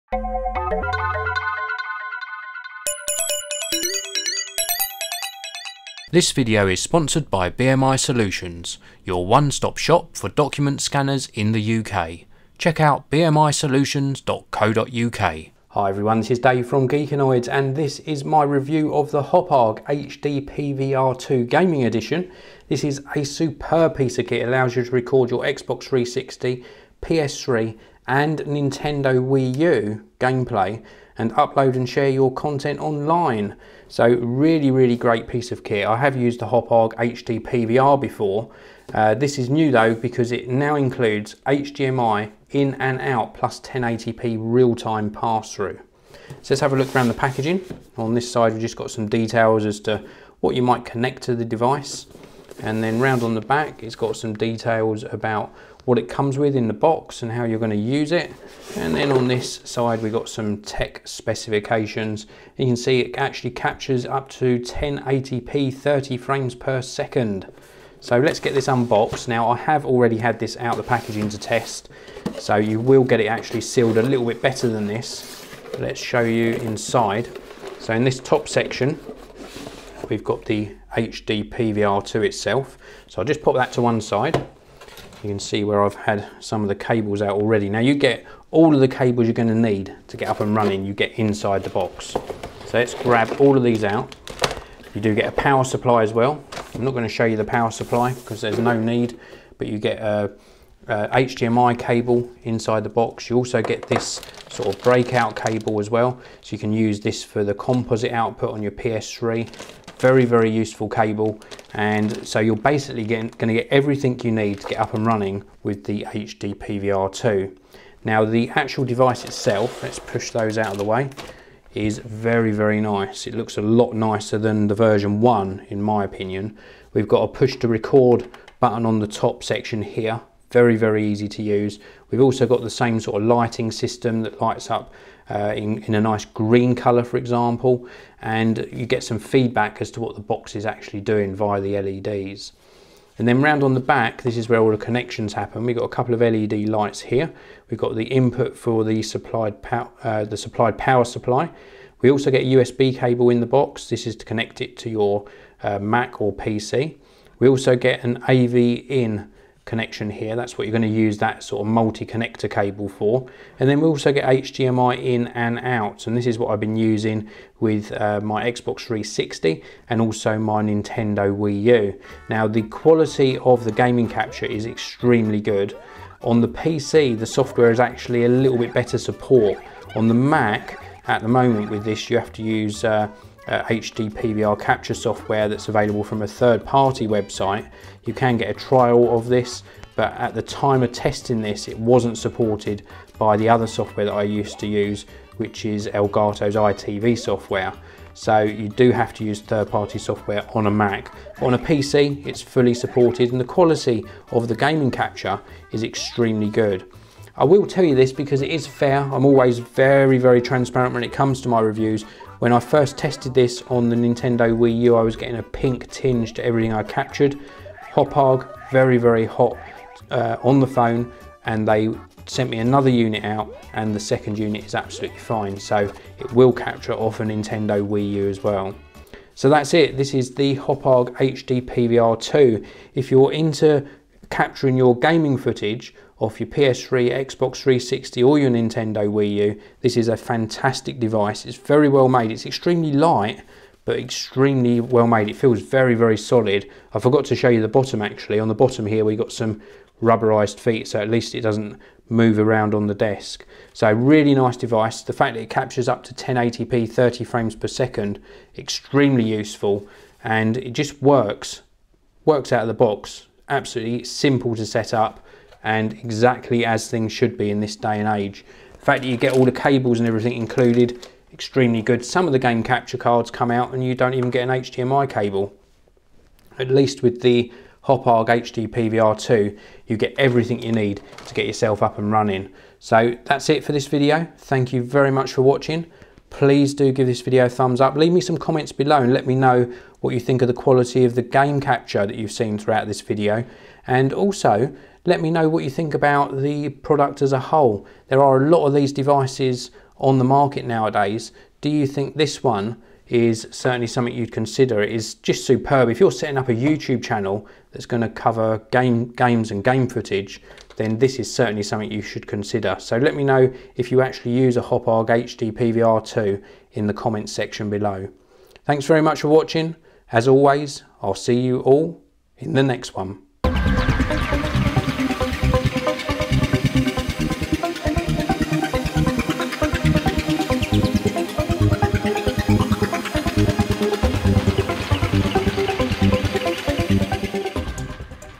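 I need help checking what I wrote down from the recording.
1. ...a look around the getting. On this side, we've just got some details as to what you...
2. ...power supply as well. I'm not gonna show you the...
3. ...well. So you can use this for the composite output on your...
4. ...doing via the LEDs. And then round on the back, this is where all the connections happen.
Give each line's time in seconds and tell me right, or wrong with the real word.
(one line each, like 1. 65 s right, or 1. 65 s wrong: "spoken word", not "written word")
1. 46 s wrong: "packaging", not "getting"
2. 95 s right
3. 105 s right
4. 141 s right.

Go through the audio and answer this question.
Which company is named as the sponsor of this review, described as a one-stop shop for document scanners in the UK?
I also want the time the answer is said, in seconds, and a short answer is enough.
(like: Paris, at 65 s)
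BMI Solutions, at 7 s.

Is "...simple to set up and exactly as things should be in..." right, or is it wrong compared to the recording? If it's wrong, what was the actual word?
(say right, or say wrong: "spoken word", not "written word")
right.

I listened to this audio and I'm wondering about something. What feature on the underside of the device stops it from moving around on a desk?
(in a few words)
Rubberized feet.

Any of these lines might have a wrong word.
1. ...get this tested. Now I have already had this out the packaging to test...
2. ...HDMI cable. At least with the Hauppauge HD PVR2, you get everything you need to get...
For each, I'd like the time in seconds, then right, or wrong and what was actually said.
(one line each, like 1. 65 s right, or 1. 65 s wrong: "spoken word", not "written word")
1. 68 s wrong: "unboxed", not "tested"
2. 274 s right.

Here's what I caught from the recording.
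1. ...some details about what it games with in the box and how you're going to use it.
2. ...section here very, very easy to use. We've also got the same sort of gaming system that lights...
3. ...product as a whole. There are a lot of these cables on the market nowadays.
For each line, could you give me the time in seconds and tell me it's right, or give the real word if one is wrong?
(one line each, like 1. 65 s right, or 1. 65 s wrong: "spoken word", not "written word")
1. 54 s wrong: "comes", not "games"
2. 129 s wrong: "lighting", not "gaming"
3. 296 s wrong: "devices", not "cables".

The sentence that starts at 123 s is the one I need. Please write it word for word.
It looks a lot nicer than the version 1 in my opinion.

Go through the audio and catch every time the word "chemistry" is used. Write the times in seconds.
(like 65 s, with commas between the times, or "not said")
not said.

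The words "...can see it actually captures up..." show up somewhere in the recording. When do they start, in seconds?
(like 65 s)
62 s.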